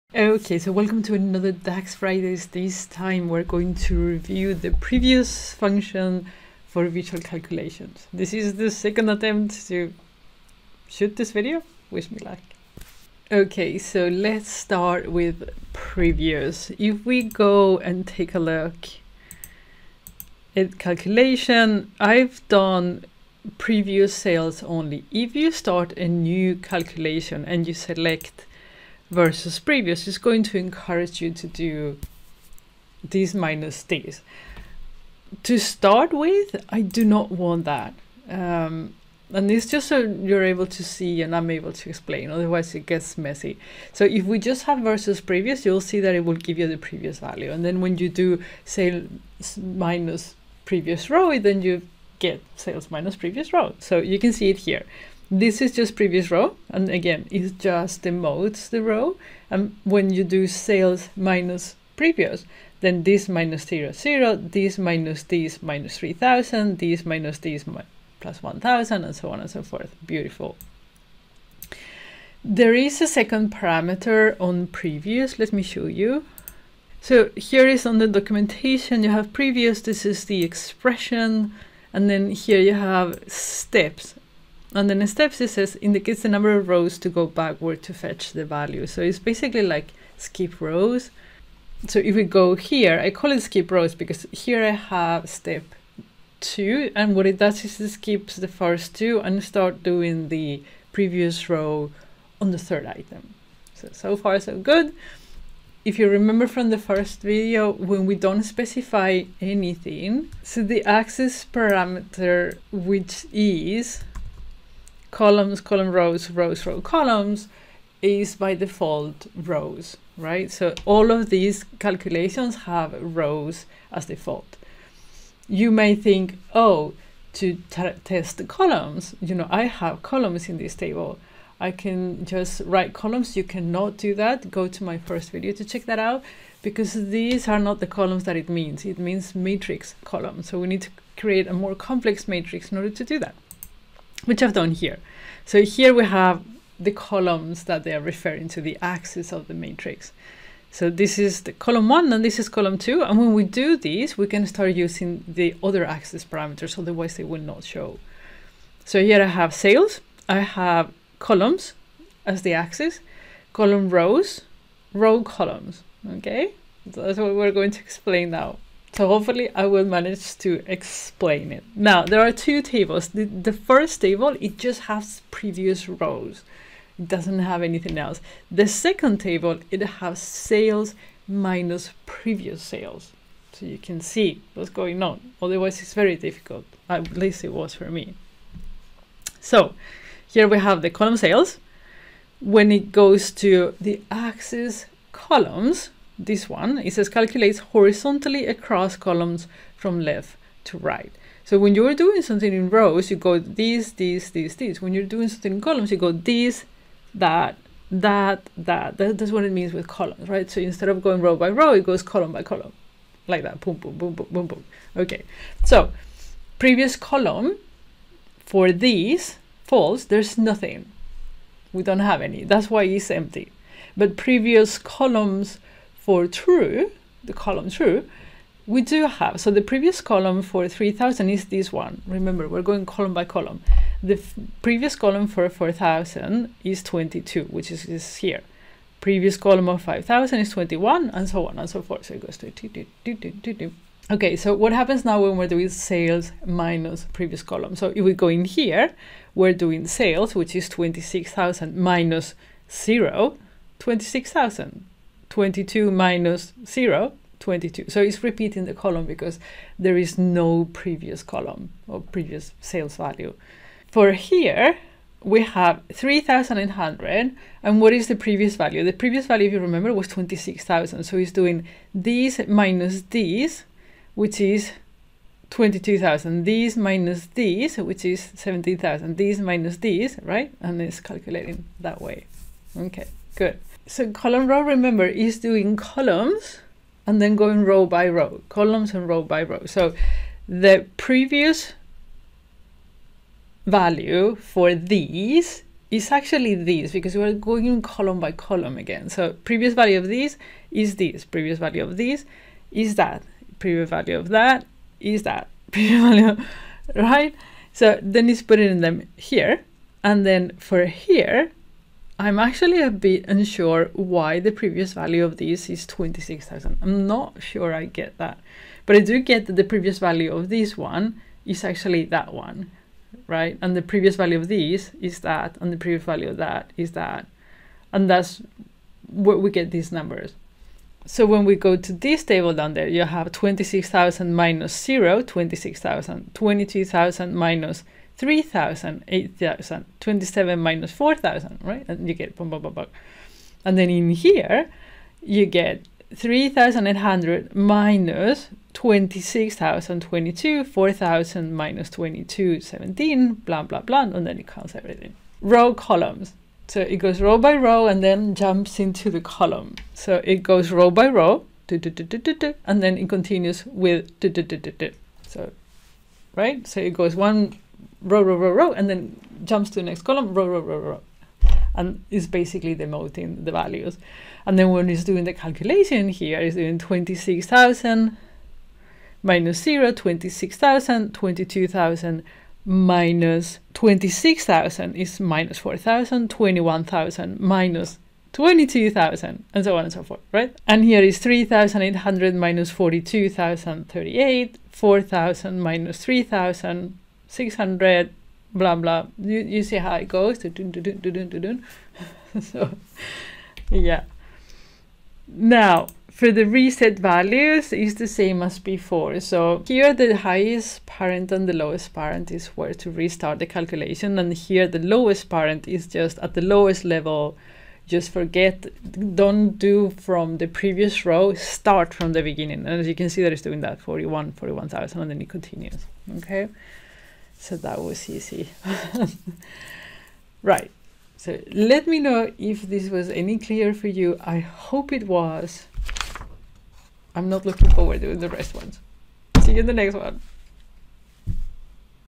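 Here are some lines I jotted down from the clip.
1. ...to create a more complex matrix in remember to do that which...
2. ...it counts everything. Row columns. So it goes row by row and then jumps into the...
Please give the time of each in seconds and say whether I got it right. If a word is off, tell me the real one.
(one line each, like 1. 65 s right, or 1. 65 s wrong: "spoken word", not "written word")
1. 140 s wrong: "order", not "remember"
2. 354 s right.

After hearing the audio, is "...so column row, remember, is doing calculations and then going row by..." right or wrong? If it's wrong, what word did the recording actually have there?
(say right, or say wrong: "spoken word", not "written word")
wrong: "columns", not "calculations".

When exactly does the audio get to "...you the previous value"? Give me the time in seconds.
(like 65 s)
46 s.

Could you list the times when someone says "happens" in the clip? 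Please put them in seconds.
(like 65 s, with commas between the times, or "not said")
244 s.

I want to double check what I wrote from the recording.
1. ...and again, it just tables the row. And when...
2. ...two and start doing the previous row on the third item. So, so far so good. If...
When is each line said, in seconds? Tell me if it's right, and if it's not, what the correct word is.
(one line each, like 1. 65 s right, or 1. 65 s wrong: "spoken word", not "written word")
1. 56 s wrong: "demotes", not "tables"
2. 98 s right.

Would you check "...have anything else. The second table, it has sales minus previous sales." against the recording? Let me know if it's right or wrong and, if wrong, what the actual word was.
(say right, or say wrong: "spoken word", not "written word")
right.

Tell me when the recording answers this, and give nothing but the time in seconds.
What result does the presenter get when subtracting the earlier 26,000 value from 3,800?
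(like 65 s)
274 s.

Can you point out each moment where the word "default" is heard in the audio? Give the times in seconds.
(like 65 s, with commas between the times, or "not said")
118 s, 124 s.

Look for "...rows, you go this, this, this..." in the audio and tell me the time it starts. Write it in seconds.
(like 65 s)
202 s.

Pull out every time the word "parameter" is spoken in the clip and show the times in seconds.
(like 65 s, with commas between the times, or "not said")
73 s, 111 s, 156 s.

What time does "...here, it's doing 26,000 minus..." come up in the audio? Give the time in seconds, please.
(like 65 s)
376 s.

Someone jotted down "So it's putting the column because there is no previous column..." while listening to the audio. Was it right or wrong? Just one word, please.
wrong.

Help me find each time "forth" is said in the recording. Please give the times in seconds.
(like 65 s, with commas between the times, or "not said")
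69 s, 241 s, 390 s.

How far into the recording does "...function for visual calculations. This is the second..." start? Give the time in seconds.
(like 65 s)
5 s.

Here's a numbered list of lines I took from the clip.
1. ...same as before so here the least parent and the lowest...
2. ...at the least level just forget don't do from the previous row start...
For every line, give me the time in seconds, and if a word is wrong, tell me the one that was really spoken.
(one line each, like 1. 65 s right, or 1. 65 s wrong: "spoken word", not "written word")
1. 408 s wrong: "highest", not "least"
2. 416 s wrong: "lowest", not "least".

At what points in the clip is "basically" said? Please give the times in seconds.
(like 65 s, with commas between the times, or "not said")
89 s, 372 s.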